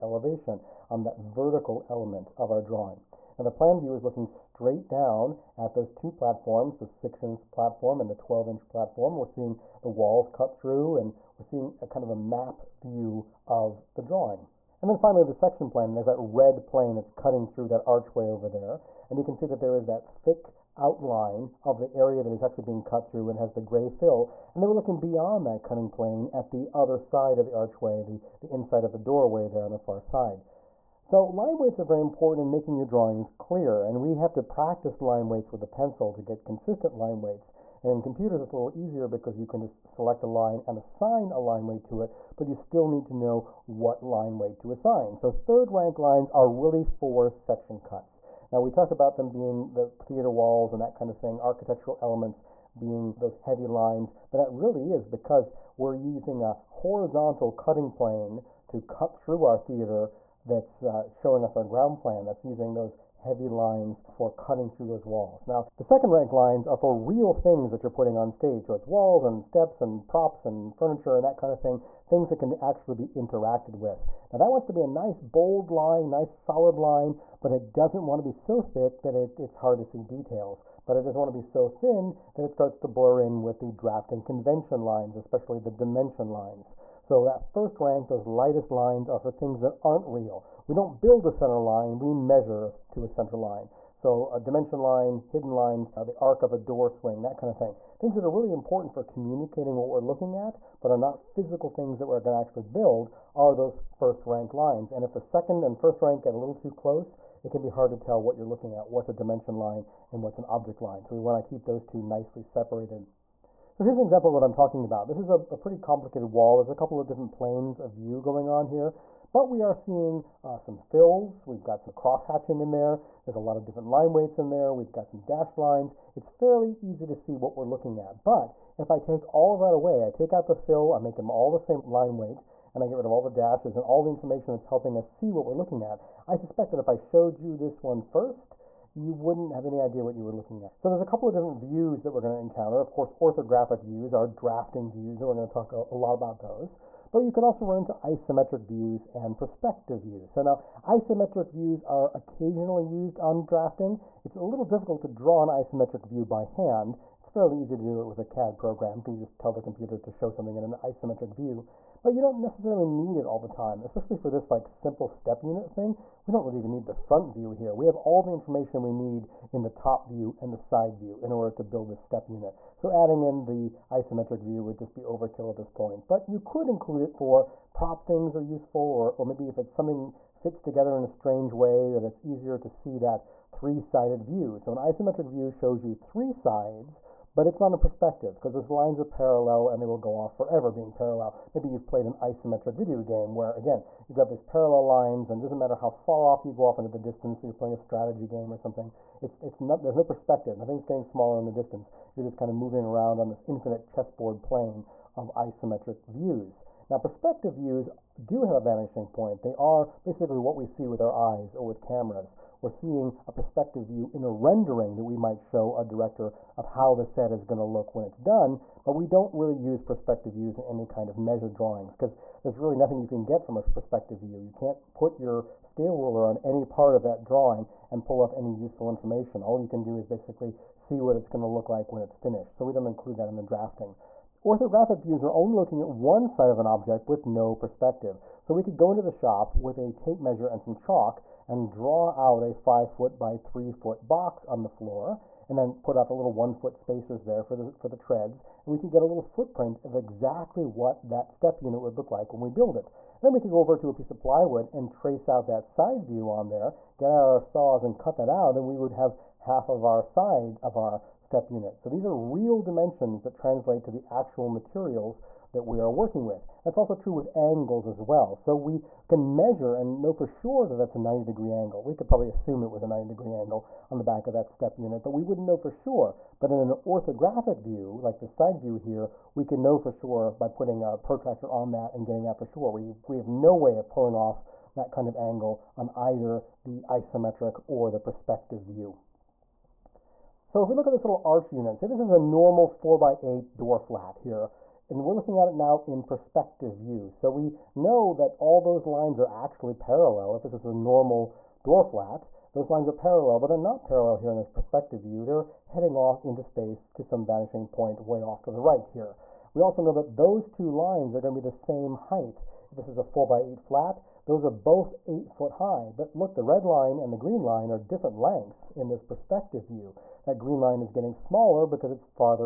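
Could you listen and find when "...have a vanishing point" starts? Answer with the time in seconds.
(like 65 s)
208 s.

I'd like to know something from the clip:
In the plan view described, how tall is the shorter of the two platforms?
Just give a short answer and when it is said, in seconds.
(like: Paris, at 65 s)
6 inch, at 6 s.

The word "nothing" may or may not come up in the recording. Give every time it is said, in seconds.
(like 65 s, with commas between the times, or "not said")
200 s, 222 s.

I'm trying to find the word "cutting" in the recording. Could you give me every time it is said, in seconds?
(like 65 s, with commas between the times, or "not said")
17 s, 25 s, 57 s, 64 s.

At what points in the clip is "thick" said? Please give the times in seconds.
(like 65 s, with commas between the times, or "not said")
20 s, 78 s.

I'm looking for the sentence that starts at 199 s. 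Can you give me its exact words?
It's, it's not, there's no perspective.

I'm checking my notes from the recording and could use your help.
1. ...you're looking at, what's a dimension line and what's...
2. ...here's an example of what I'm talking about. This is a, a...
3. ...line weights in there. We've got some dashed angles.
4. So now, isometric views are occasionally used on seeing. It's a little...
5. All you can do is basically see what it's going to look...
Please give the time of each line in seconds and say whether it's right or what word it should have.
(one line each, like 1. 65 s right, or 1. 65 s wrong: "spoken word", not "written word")
1. 108 s right
2. 113 s right
3. 123 s wrong: "lines", not "angles"
4. 150 s wrong: "drafting", not "seeing"
5. 229 s right.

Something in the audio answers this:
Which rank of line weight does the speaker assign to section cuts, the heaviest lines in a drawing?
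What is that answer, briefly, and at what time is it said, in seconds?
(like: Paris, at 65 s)
Third rank, at 45 s.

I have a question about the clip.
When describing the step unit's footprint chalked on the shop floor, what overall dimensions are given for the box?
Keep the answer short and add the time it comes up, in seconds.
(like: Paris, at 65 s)
5 foot by 3 foot, at 242 s.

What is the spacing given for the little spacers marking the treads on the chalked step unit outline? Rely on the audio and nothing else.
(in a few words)
1 foot.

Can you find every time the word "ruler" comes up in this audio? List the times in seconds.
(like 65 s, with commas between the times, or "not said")
225 s.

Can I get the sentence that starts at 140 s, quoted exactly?
So there's a couple of different views that we're going to encounter.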